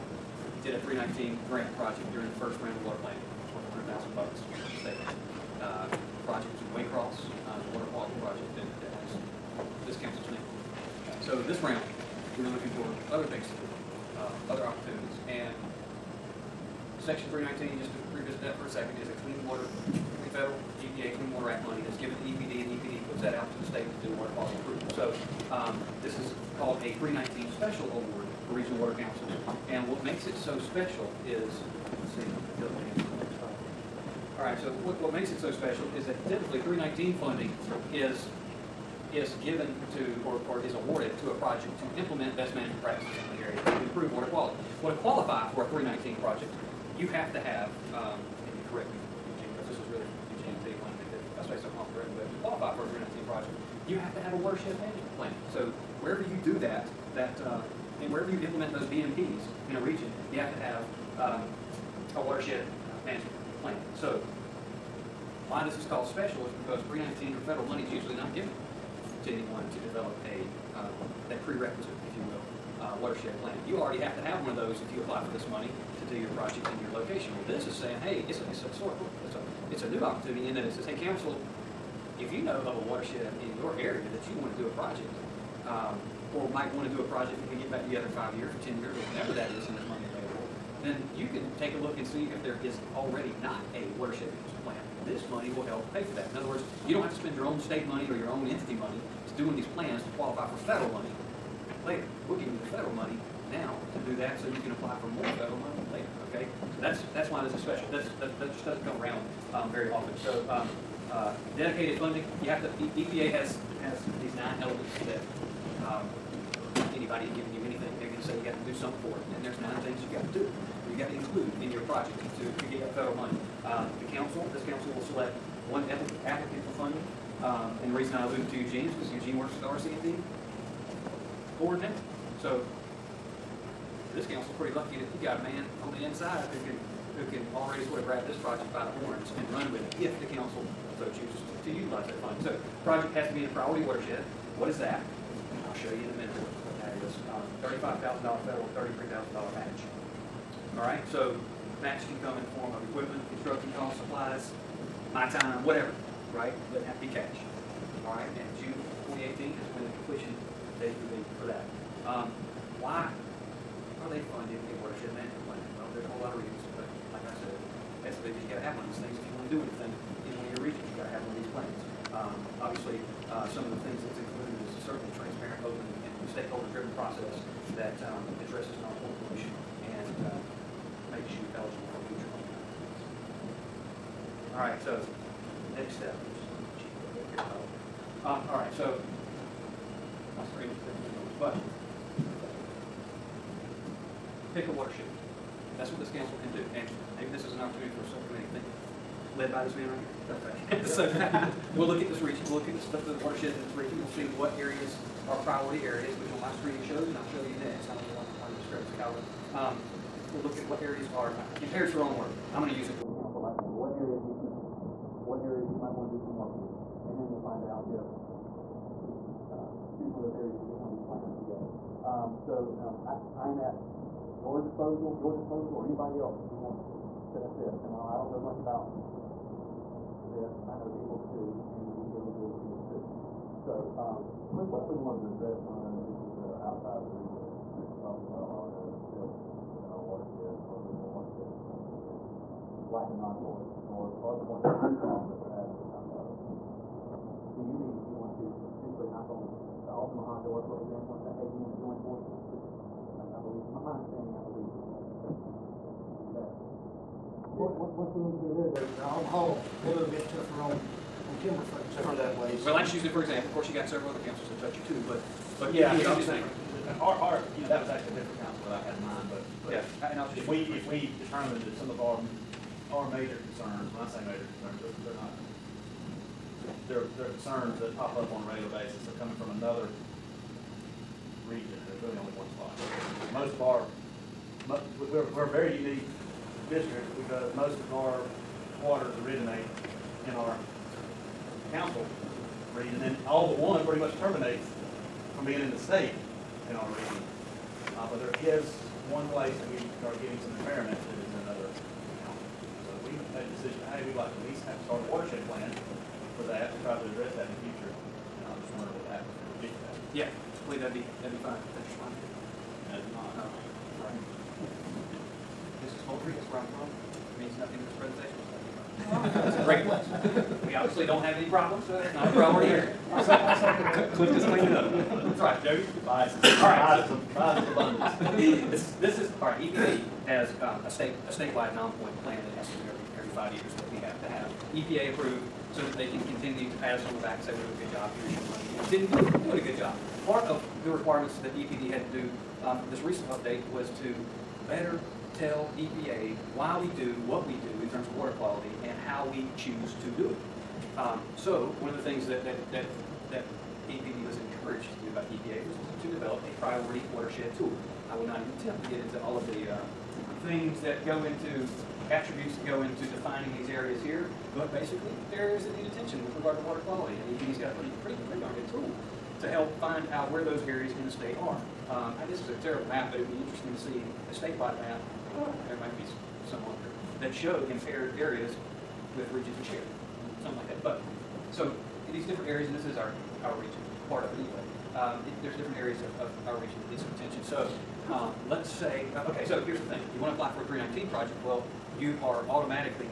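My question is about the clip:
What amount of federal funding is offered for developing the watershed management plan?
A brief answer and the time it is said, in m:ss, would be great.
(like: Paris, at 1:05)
$25,000, at 2:27.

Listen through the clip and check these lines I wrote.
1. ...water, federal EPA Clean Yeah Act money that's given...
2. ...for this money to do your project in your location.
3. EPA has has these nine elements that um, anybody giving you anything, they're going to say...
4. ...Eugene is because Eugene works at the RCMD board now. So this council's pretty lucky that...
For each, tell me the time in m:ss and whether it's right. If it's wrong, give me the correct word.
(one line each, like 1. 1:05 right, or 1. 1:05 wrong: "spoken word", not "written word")
1. 0:19 wrong: "Water", not "Yeah"
2. 1:15 right
3. 1:52 right
4. 2:08 right.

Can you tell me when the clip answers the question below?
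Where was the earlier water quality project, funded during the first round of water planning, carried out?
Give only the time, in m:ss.
0:06.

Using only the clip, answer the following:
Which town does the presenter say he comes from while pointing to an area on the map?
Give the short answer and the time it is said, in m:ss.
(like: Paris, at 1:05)
Moultrie, at 5:16.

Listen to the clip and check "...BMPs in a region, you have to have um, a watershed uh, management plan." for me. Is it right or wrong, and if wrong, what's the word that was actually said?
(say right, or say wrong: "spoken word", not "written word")
right.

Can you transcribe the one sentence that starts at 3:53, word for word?
So, um, what if we wanted to address some of those issues that are outside of the black and non-void.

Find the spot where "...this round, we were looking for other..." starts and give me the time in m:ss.
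0:11.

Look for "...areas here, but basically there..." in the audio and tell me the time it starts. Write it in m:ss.
6:03.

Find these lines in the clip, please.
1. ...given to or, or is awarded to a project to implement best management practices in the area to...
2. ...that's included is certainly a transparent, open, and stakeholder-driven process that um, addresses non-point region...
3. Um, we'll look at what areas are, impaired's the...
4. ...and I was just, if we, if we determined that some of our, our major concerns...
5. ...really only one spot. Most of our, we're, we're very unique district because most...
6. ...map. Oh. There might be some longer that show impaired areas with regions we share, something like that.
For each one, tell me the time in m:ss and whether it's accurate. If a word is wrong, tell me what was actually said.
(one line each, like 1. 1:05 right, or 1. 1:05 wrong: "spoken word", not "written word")
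1. 0:39 right
2. 2:54 wrong: "pollution", not "region"
3. 3:29 right
4. 4:30 right
5. 4:42 right
6. 6:14 right.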